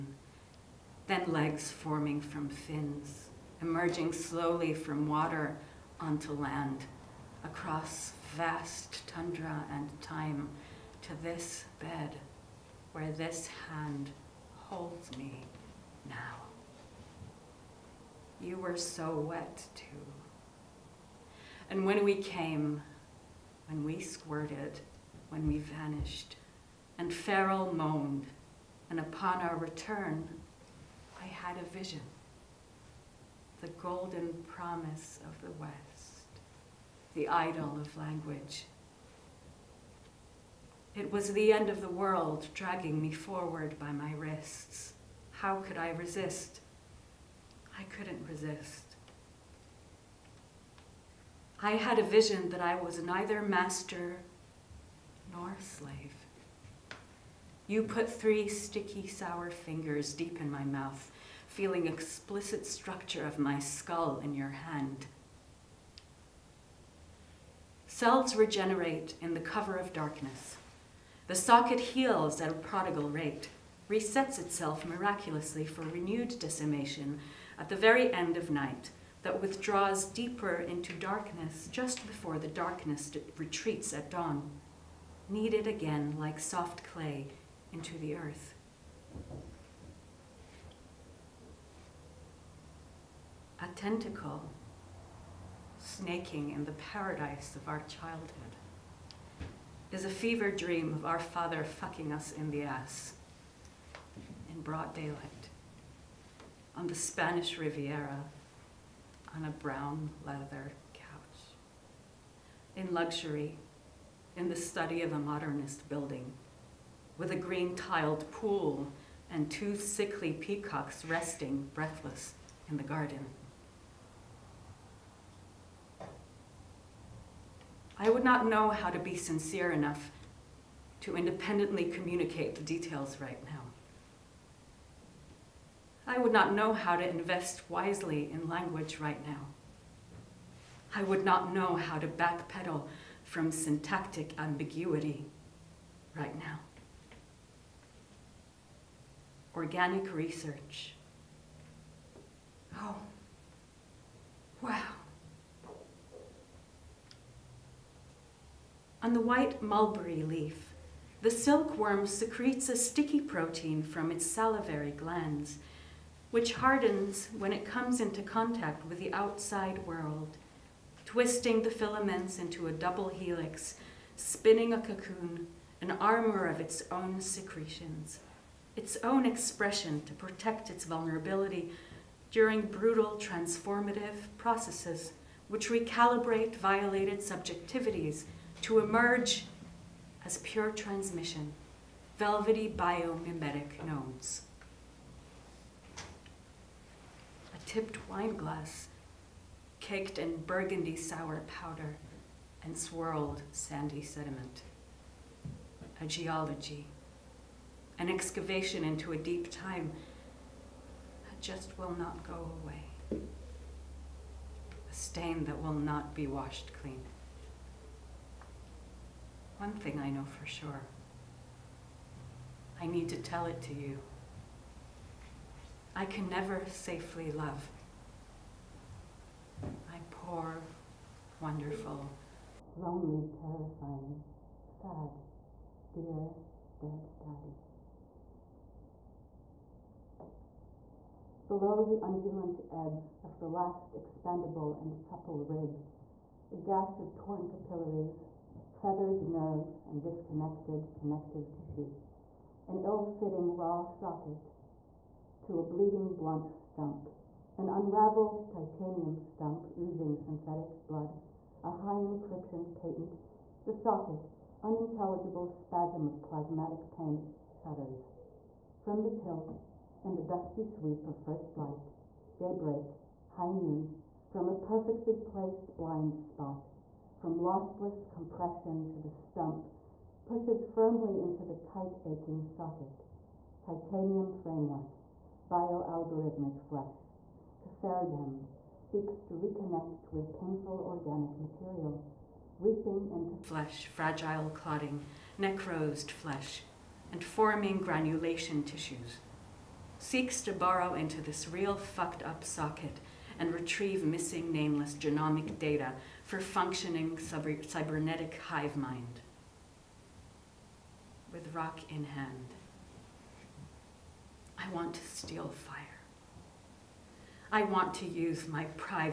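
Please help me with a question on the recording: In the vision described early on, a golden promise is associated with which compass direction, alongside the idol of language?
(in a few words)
the West.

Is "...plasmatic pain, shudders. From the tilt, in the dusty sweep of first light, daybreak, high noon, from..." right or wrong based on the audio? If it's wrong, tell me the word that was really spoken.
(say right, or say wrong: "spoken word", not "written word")
right.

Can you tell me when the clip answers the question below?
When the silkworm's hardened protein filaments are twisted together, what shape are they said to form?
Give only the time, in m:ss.
2:52.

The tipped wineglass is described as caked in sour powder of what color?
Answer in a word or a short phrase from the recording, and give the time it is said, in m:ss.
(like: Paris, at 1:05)
burgundy, at 3:20.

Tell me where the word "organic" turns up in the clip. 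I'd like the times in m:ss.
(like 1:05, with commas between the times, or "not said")
2:29, 4:50.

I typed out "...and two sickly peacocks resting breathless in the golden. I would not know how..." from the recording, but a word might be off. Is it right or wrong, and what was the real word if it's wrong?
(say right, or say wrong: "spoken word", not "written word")
wrong: "garden", not "golden".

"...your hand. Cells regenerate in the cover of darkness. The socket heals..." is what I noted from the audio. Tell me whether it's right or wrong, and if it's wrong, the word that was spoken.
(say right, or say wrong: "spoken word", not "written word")
right.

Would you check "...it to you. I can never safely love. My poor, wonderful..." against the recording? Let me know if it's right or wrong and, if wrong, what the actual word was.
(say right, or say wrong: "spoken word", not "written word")
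right.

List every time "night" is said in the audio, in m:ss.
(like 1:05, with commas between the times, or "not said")
1:18.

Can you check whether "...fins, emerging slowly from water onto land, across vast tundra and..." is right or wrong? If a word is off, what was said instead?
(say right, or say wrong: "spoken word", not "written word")
right.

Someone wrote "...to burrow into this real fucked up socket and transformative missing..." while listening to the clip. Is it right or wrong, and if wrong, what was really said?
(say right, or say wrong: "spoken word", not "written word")
wrong: "retrieve", not "transformative".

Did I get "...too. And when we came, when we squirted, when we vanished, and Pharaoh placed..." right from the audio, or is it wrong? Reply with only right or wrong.
wrong.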